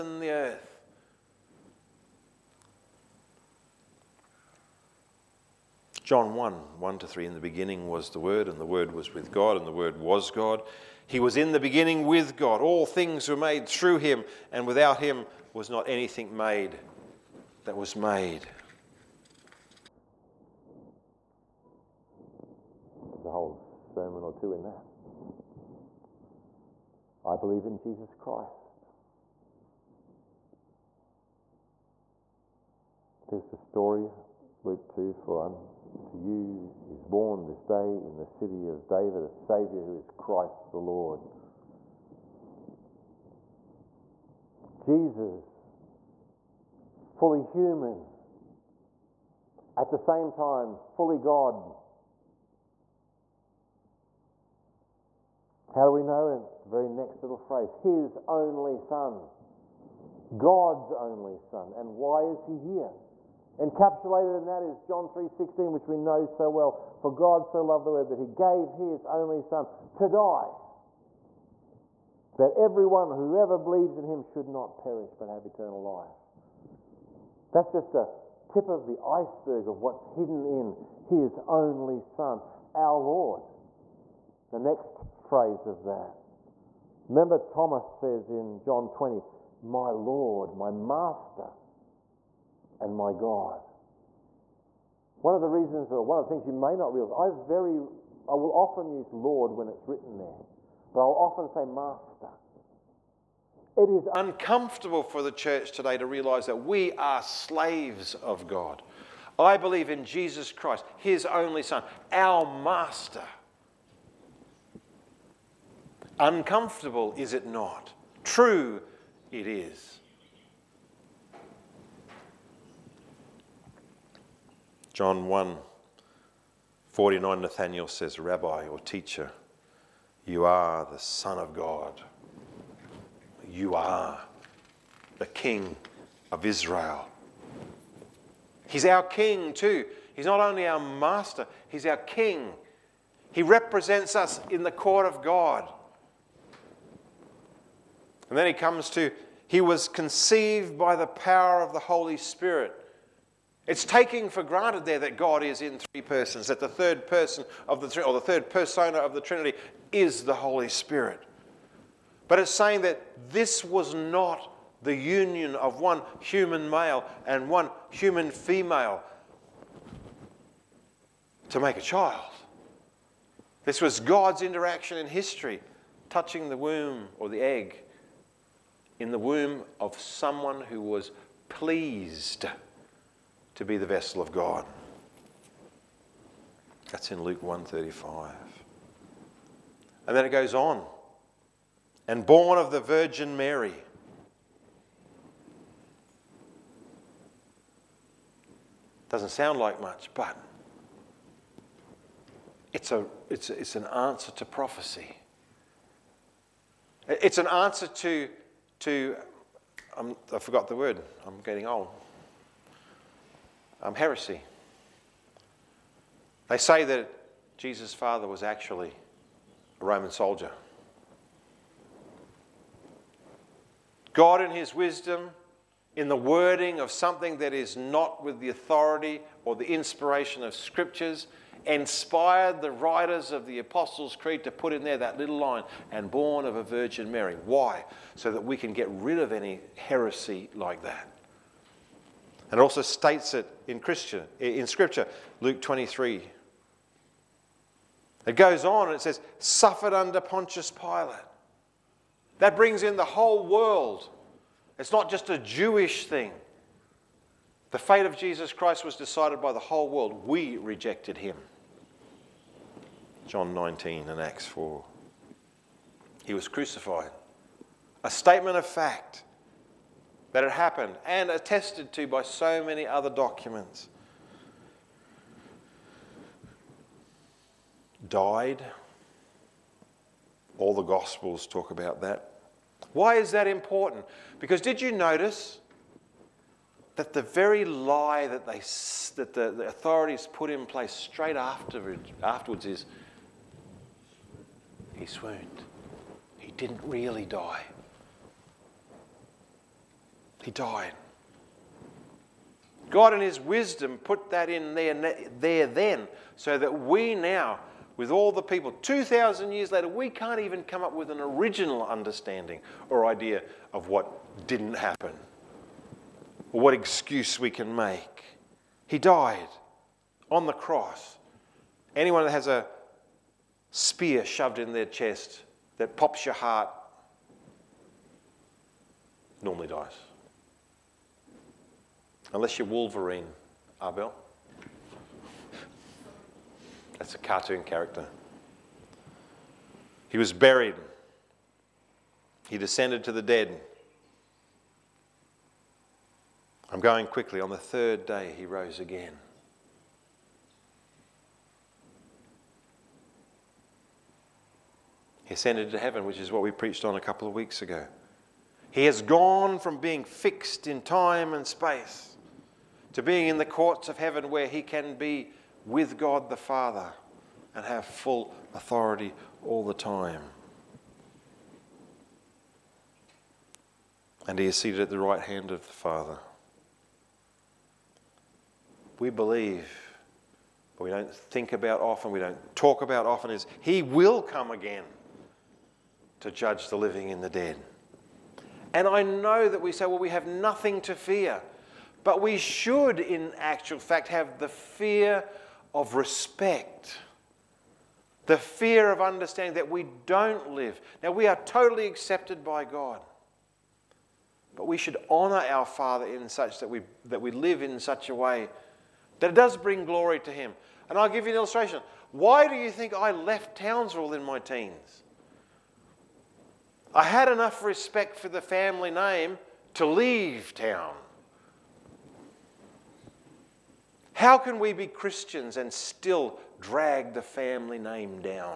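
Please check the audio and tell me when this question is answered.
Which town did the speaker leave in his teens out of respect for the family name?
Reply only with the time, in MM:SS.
06:53.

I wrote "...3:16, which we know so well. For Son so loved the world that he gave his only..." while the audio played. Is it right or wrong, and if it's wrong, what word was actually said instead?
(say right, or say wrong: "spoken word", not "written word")
wrong: "God", not "Son".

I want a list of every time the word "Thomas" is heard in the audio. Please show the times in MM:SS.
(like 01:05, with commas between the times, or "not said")
01:27.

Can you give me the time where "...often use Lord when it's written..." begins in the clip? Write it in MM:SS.
01:38.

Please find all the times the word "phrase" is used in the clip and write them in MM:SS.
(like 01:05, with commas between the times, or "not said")
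00:57, 01:25.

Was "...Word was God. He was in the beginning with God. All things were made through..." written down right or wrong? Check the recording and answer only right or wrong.
right.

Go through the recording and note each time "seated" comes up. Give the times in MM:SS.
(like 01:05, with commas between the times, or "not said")
06:14.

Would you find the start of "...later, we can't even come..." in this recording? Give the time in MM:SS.
05:09.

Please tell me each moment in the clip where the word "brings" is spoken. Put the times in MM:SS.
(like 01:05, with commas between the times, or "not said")
04:12, 06:49.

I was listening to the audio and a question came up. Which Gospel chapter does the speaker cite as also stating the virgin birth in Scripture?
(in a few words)
Luke 23.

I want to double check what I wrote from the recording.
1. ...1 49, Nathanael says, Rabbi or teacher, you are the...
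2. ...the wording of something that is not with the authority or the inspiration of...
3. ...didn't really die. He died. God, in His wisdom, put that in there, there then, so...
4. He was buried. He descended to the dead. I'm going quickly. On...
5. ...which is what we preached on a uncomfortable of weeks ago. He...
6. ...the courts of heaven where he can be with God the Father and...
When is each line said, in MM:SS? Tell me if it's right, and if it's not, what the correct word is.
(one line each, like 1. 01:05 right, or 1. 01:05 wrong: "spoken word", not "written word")
1. 02:05 right
2. 03:46 right
3. 04:56 right
4. 05:40 right
5. 05:56 wrong: "couple", not "uncomfortable"
6. 06:03 right.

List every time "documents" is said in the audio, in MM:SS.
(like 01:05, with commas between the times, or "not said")
04:33.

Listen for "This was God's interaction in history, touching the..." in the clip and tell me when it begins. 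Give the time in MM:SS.
02:53.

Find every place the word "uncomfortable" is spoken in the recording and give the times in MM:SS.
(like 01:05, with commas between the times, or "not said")
01:44, 01:56.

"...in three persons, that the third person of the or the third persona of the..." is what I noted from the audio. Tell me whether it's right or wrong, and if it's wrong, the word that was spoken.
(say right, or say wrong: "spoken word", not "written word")
right.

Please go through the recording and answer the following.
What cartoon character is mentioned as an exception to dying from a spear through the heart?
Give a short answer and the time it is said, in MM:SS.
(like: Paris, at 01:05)
Wolverine, at 05:32.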